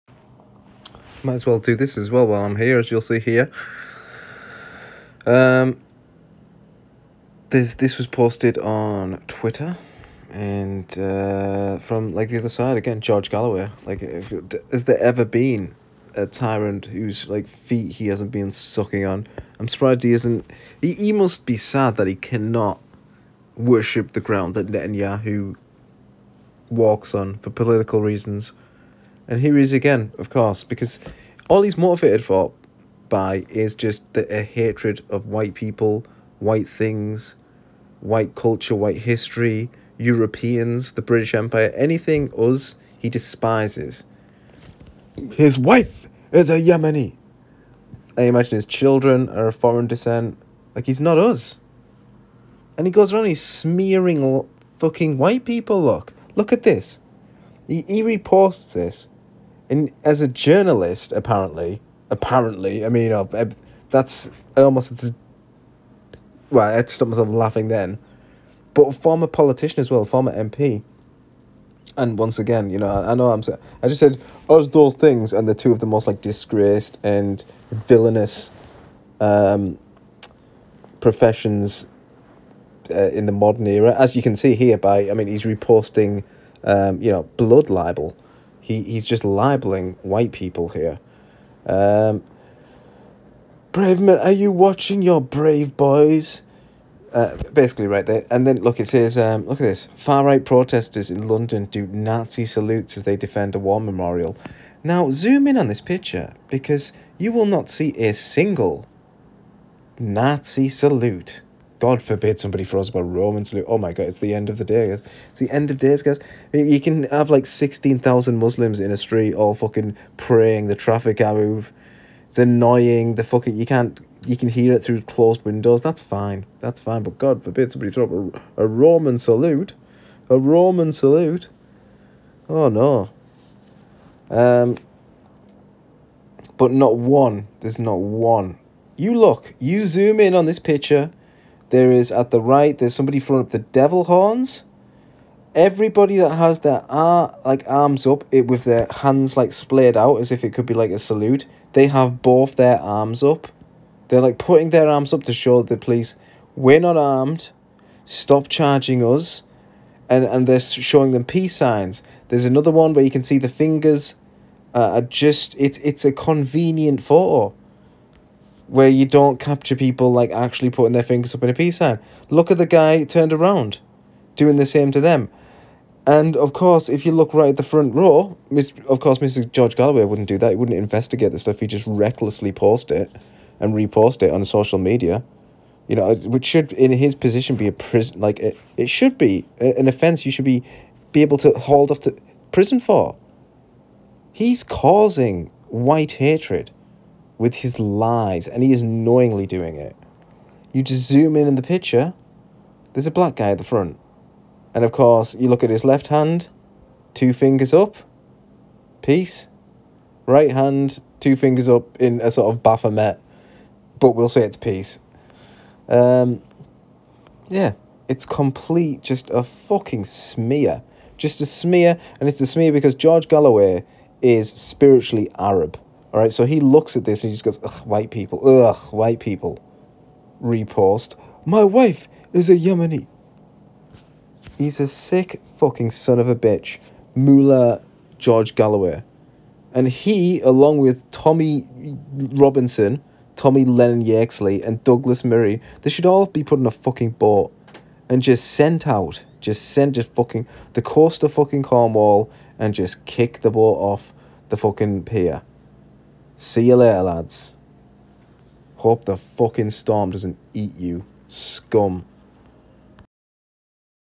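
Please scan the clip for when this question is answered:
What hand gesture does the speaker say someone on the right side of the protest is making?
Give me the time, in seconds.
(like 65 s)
143 s.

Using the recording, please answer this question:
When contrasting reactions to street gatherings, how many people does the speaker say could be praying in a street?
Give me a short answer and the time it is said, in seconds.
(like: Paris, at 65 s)
16,000, at 117 s.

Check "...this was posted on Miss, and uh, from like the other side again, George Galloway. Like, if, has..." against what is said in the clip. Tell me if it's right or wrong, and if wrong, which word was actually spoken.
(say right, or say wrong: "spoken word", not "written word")
wrong: "Twitter", not "Miss".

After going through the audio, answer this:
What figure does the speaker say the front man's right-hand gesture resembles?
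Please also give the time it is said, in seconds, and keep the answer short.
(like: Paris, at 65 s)
Baphomet, at 212 s.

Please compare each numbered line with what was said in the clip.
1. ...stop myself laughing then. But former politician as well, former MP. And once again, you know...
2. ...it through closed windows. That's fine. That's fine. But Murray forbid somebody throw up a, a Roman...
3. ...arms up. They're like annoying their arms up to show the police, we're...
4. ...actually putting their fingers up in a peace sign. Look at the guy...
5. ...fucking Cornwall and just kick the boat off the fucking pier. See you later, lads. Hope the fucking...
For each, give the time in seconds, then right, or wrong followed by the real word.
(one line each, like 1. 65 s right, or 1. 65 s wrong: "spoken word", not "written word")
1. 66 s right
2. 124 s wrong: "God", not "Murray"
3. 152 s wrong: "putting", not "annoying"
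4. 170 s right
5. 251 s right.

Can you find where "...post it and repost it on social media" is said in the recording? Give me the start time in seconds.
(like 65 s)
182 s.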